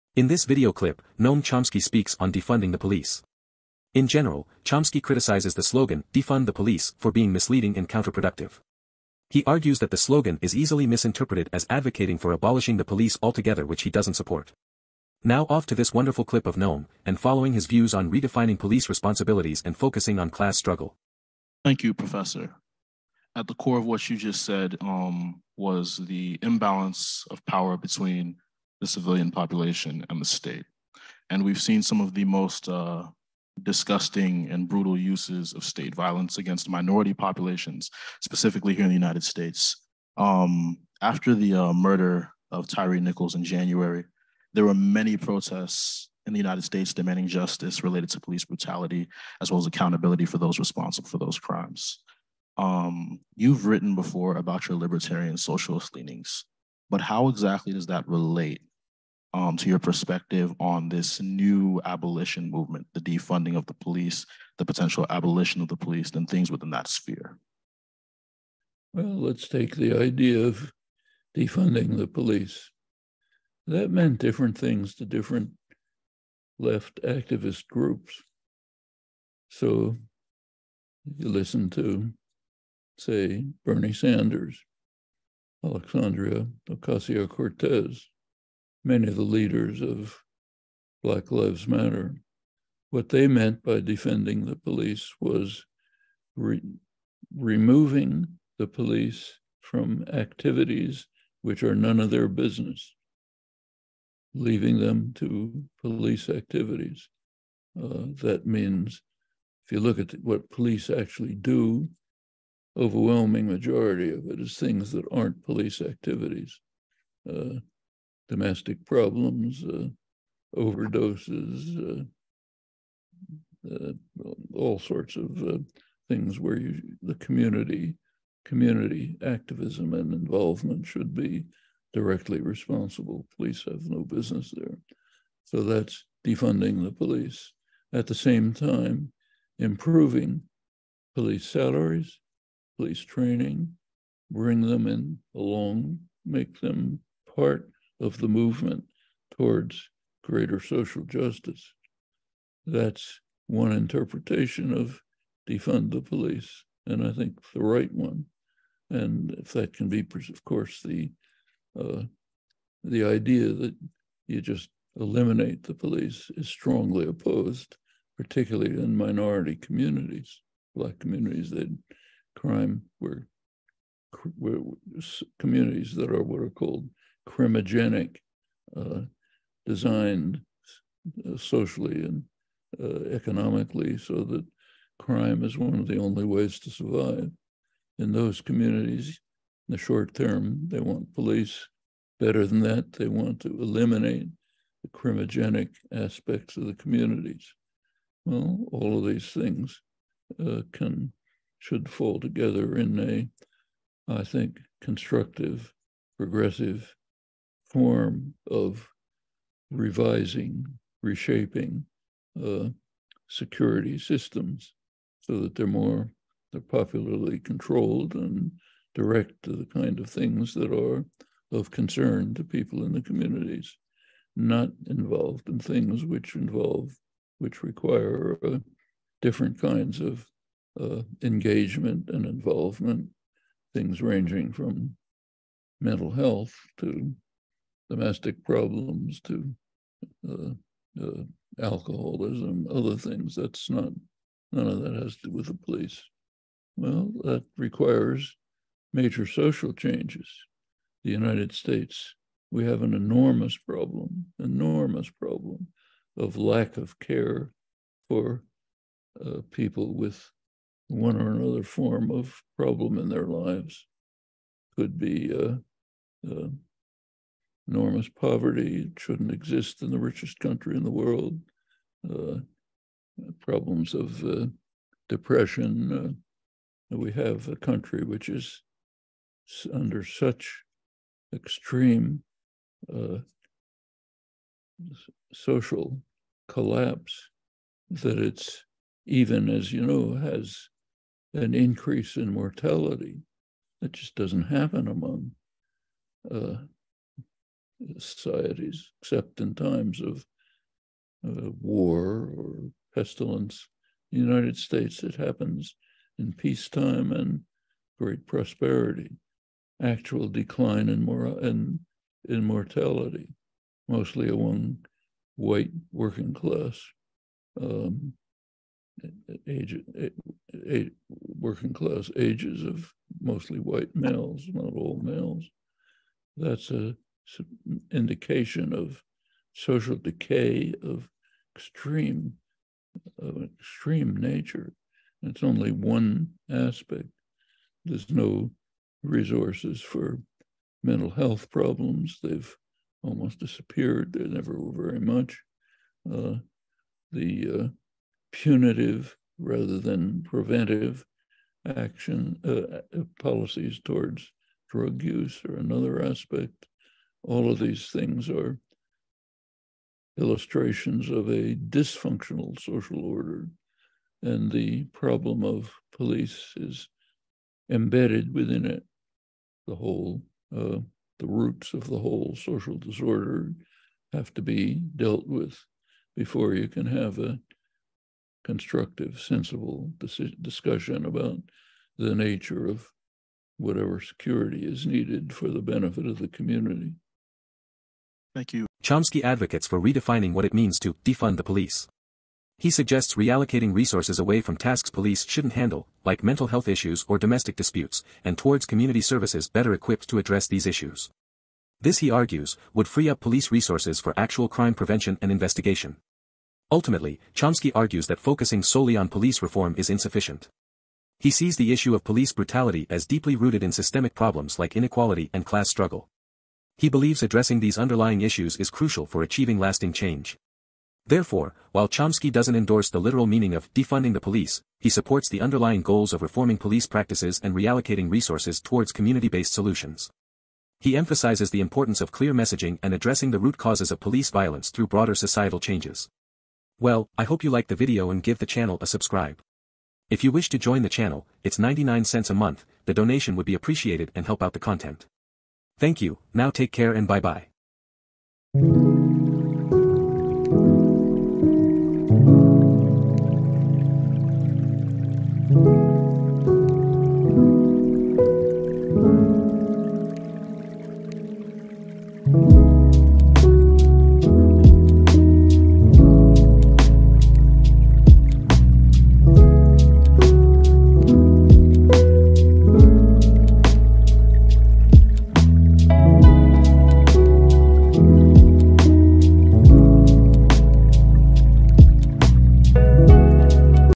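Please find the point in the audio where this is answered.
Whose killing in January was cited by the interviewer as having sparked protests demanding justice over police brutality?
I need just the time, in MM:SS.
00:42.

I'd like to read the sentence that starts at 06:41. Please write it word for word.
This, he argues, would free up police resources for actual crime prevention and investigation.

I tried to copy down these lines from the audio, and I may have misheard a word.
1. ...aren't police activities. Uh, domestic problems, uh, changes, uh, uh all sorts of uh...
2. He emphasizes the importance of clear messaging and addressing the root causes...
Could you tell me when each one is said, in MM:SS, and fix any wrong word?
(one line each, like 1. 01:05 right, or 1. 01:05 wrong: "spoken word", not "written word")
1. 01:55 wrong: "overdoses", not "changes"
2. 07:10 right.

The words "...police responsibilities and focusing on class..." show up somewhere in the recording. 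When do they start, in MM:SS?
00:18.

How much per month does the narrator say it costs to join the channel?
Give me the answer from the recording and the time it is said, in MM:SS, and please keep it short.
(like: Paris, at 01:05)
99 cents, at 07:21.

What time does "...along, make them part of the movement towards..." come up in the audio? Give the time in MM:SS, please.
02:25.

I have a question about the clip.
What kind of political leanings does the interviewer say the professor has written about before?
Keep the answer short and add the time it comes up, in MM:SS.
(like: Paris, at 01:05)
libertarian socialist, at 00:54.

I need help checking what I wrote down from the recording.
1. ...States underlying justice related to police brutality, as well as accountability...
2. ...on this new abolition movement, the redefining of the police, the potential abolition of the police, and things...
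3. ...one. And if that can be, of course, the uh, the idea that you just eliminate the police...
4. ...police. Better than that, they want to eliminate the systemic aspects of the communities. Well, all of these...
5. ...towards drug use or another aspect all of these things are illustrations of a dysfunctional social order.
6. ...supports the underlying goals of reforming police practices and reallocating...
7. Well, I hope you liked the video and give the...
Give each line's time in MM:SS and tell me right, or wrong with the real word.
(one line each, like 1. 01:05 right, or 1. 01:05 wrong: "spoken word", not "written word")
1. 00:46 wrong: "demanding", not "underlying"
2. 01:00 wrong: "defunding", not "redefining"
3. 02:37 right
4. 03:11 wrong: "criminogenic", not "systemic"
5. 05:53 right
6. 07:04 right
7. 07:16 right.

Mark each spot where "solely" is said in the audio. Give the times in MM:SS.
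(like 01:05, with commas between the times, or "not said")
06:48.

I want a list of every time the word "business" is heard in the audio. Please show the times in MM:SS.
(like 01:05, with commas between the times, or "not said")
01:42, 02:14.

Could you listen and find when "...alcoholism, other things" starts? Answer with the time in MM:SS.
04:01.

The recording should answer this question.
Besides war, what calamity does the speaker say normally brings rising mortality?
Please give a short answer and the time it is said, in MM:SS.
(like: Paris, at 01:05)
pestilence, at 05:02.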